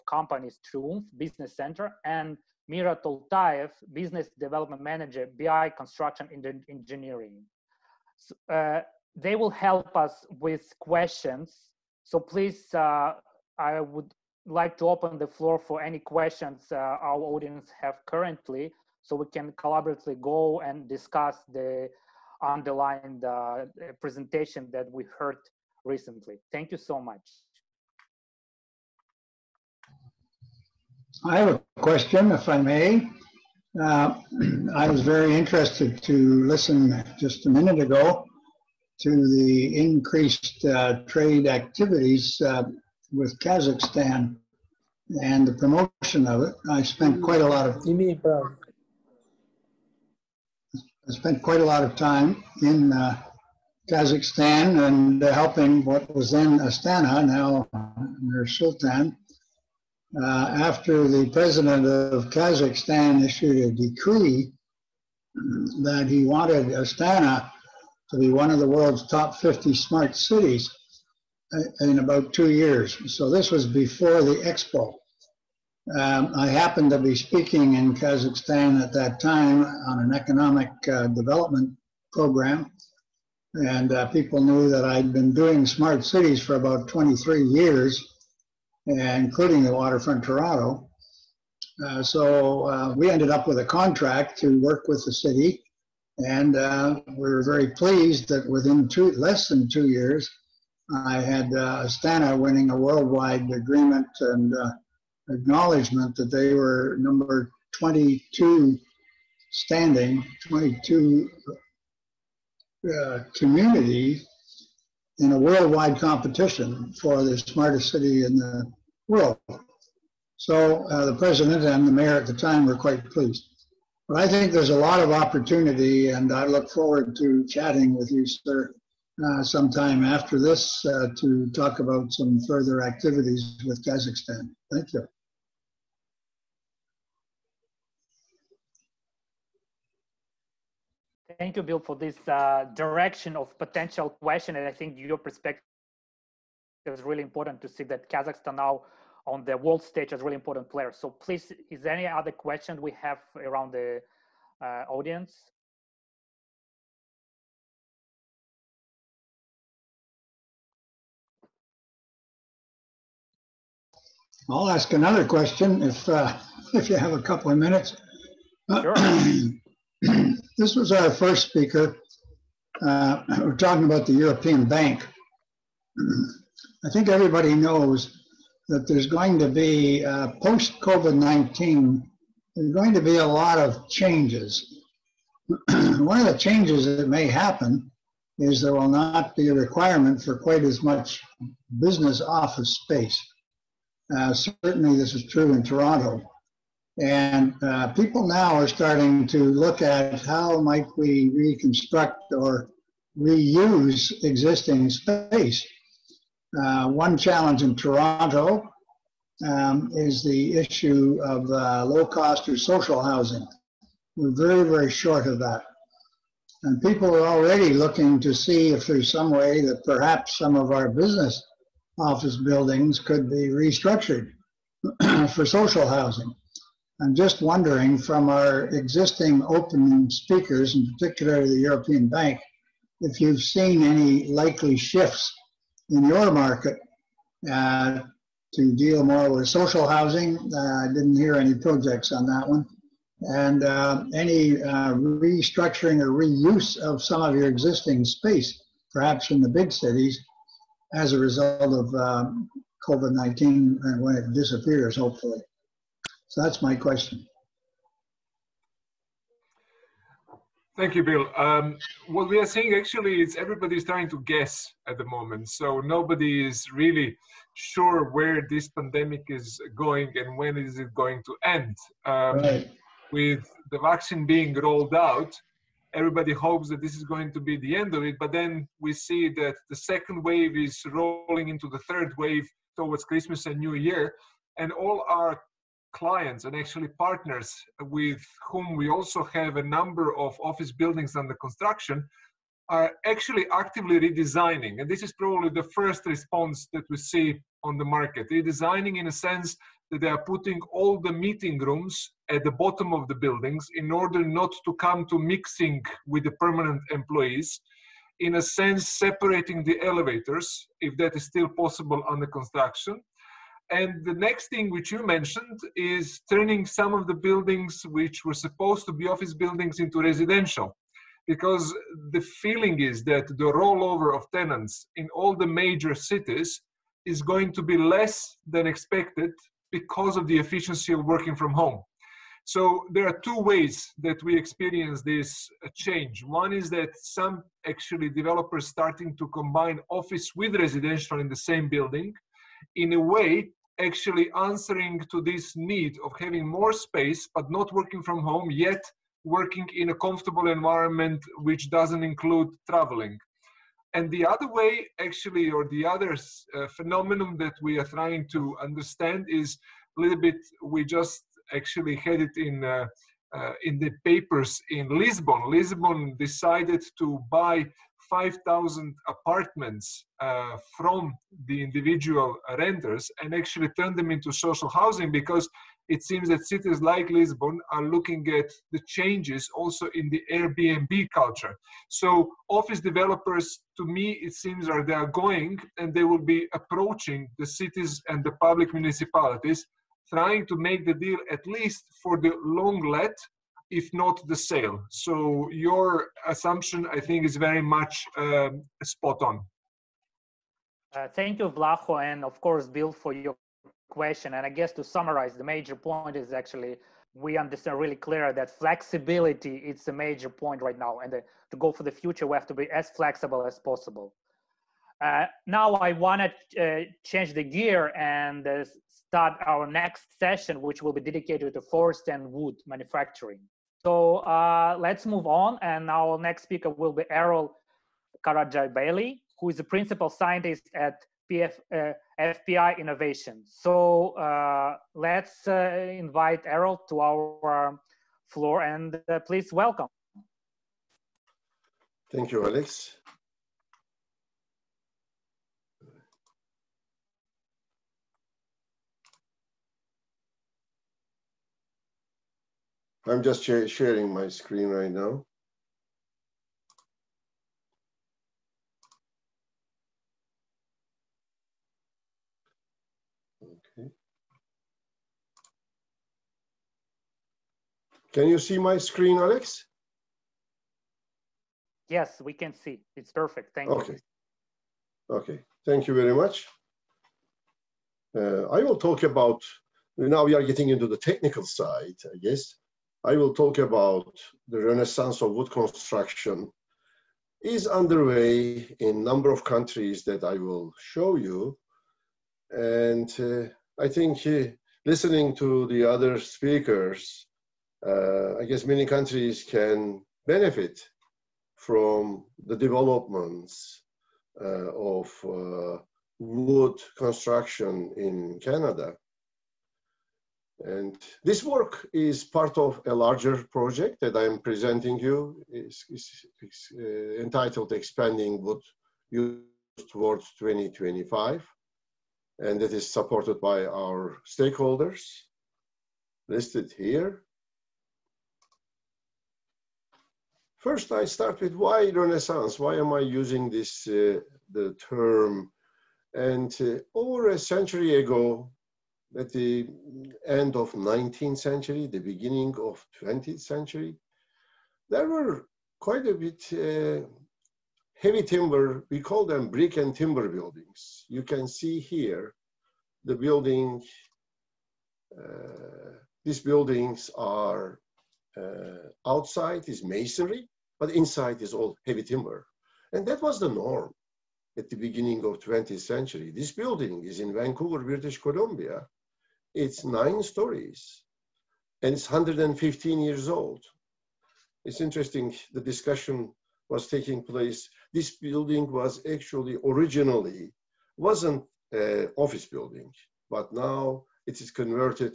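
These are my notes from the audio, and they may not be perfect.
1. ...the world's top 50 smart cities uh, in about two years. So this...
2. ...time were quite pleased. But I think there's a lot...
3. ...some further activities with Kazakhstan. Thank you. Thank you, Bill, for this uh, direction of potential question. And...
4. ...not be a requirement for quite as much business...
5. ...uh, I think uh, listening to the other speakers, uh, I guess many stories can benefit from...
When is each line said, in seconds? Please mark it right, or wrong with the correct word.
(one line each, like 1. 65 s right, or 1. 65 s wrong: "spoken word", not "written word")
1. 68 s right
2. 122 s right
3. 132 s right
4. 188 s right
5. 493 s wrong: "countries", not "stories".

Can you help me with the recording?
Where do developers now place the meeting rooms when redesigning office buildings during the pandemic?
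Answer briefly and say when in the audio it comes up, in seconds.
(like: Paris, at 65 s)
At the bottom of the buildings, at 302 s.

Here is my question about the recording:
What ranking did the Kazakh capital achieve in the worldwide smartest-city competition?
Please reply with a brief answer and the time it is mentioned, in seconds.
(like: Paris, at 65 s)
22, at 106 s.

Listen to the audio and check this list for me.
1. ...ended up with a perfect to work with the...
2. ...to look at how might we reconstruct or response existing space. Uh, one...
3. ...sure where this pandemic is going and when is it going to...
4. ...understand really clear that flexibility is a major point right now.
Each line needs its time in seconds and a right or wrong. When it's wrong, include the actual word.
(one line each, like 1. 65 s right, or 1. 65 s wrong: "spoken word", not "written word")
1. 93 s wrong: "contract", not "perfect"
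2. 199 s wrong: "reuse", not "response"
3. 267 s right
4. 407 s right.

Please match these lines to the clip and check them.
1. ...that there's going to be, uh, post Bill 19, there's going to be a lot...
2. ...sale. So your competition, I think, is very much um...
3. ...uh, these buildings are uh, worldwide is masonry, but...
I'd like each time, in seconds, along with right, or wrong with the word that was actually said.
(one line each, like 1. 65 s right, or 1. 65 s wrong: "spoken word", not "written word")
1. 178 s wrong: "COVID", not "Bill"
2. 394 s wrong: "assumption", not "competition"
3. 555 s wrong: "outside", not "worldwide".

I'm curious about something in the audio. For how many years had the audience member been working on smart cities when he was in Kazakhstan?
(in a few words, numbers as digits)
23 years.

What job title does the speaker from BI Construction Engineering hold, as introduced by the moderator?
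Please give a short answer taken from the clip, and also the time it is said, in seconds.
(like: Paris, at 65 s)
Business Development Manager, at 3 s.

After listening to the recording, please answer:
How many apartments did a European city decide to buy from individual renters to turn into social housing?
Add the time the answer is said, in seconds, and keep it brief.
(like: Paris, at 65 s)
5,000, at 368 s.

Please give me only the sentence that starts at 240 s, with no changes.
Uh, I didn't hear any projects on that one.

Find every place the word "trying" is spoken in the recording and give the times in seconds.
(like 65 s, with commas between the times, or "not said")
263 s, 357 s, 390 s.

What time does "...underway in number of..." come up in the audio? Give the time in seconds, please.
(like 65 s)
487 s.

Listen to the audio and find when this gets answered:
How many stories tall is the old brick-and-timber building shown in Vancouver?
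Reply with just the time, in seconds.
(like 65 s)
569 s.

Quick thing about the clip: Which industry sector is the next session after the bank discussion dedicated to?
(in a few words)
Forest and wood manufacturing.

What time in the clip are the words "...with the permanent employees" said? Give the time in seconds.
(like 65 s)
306 s.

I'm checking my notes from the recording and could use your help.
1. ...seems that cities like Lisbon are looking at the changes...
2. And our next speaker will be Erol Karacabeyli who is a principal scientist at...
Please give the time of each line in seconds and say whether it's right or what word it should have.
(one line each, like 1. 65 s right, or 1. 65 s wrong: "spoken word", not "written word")
1. 376 s right
2. 425 s right.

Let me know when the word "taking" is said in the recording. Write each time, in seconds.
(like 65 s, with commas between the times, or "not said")
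576 s.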